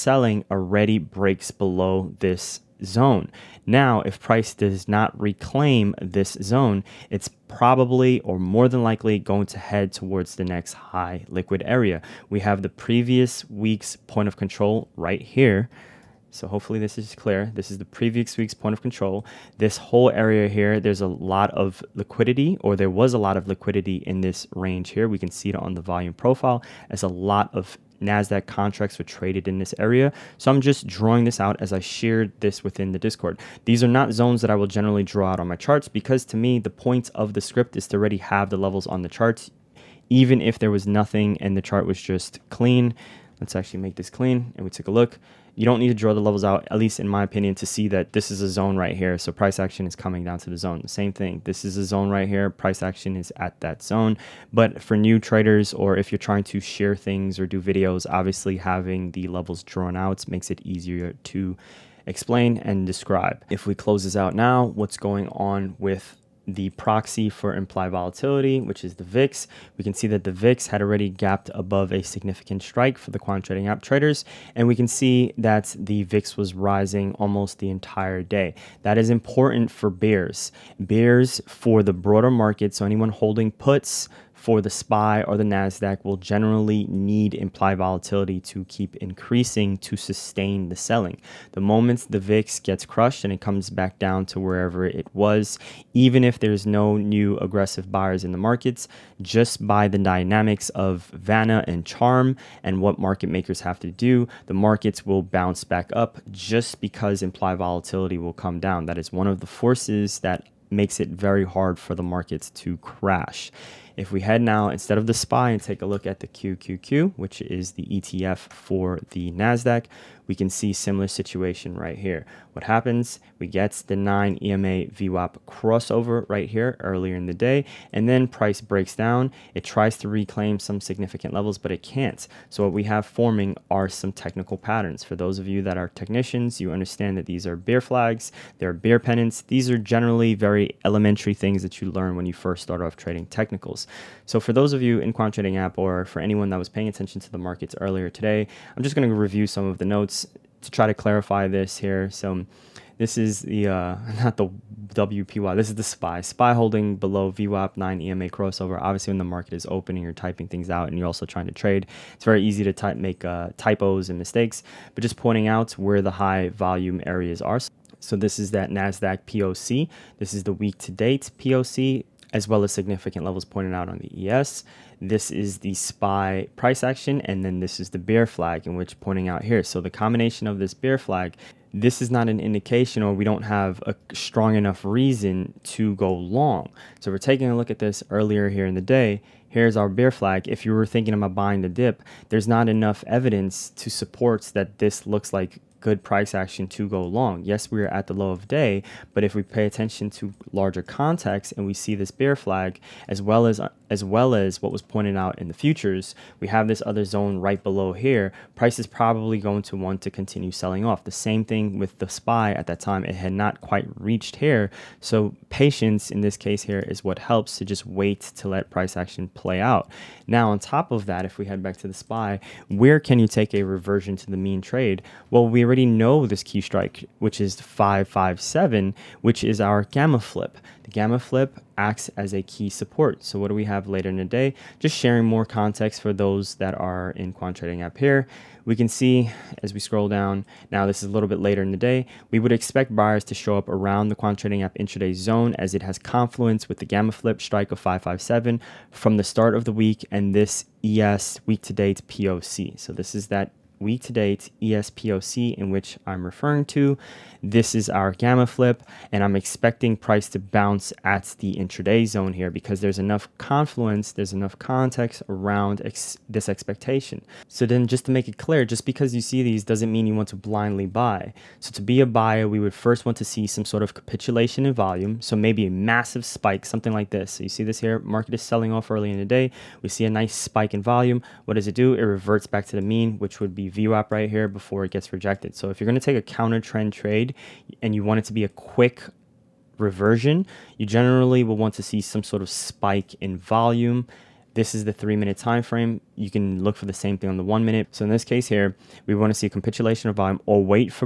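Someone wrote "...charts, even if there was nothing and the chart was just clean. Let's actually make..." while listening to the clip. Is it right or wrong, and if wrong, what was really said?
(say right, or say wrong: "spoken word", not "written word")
right.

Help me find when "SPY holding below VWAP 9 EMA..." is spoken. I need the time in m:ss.
2:36.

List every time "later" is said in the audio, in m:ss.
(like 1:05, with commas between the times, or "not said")
3:53, 4:01.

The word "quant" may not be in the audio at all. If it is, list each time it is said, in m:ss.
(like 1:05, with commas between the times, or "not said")
1:13, 2:25, 3:57, 4:04.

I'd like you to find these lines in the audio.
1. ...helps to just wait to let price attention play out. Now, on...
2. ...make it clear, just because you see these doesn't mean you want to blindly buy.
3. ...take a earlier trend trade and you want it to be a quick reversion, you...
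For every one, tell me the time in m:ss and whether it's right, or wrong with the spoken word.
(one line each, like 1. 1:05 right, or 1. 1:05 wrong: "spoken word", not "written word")
1. 3:37 wrong: "action", not "attention"
2. 4:28 right
3. 4:46 wrong: "counter", not "earlier".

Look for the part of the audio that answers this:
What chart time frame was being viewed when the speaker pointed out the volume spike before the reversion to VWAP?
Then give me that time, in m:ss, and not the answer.
4:54.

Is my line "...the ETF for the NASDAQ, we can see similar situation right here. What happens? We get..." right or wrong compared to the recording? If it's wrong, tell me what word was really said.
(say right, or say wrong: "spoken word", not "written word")
right.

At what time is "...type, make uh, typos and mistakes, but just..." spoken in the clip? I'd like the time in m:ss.
2:42.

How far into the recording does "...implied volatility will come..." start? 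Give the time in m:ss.
1:47.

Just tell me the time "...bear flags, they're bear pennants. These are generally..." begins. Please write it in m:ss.
2:17.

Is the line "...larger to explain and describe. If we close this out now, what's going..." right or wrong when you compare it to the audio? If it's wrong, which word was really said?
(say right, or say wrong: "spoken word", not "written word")
wrong: "easier", not "larger".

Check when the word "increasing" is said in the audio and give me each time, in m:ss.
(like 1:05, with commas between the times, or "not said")
1:28.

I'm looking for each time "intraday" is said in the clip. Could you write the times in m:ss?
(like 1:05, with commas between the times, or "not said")
4:04, 4:21.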